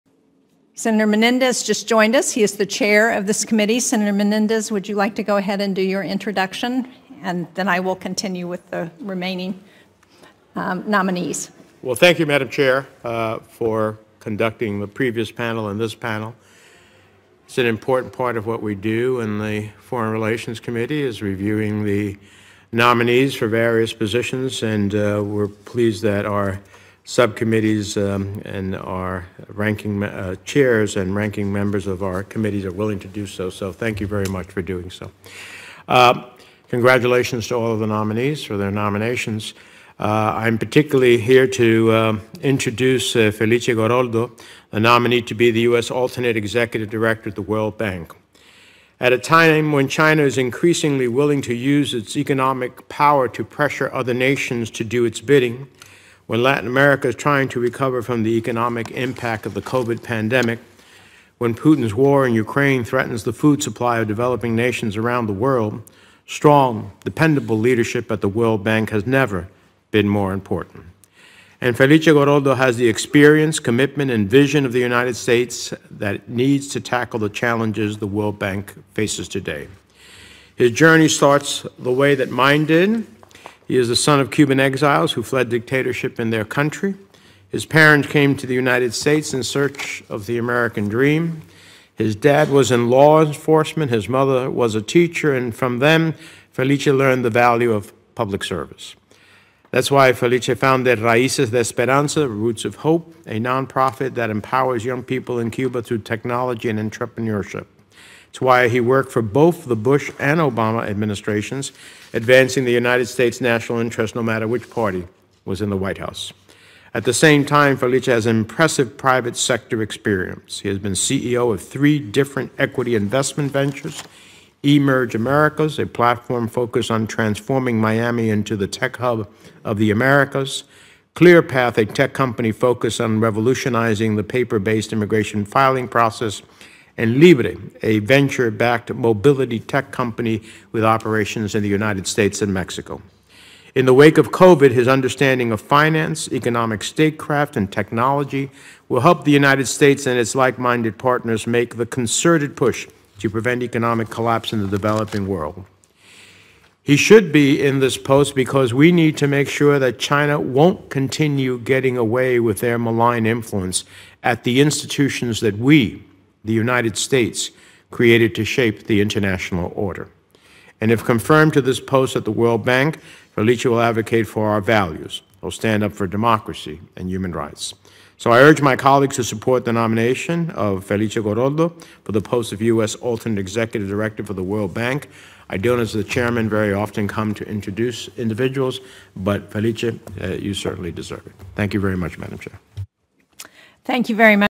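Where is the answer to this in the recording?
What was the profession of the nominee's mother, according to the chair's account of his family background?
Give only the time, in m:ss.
1:34.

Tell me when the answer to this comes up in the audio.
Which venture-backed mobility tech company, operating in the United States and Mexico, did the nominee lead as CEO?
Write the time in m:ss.
2:17.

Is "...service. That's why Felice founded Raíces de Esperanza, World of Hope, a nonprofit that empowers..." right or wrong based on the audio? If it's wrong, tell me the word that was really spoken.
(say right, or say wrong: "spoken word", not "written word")
wrong: "Roots", not "World".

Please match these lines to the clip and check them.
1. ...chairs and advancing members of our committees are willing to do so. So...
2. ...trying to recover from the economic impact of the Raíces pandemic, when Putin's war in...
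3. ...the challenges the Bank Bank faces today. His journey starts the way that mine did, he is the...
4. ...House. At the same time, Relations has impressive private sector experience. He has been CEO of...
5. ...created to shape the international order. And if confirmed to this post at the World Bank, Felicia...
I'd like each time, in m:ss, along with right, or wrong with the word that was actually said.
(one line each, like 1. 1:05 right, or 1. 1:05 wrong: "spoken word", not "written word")
1. 0:30 wrong: "ranking", not "advancing"
2. 0:57 wrong: "COVID", not "Raíces"
3. 1:17 wrong: "World", not "Bank"
4. 1:55 wrong: "Felice", not "Relations"
5. 2:47 right.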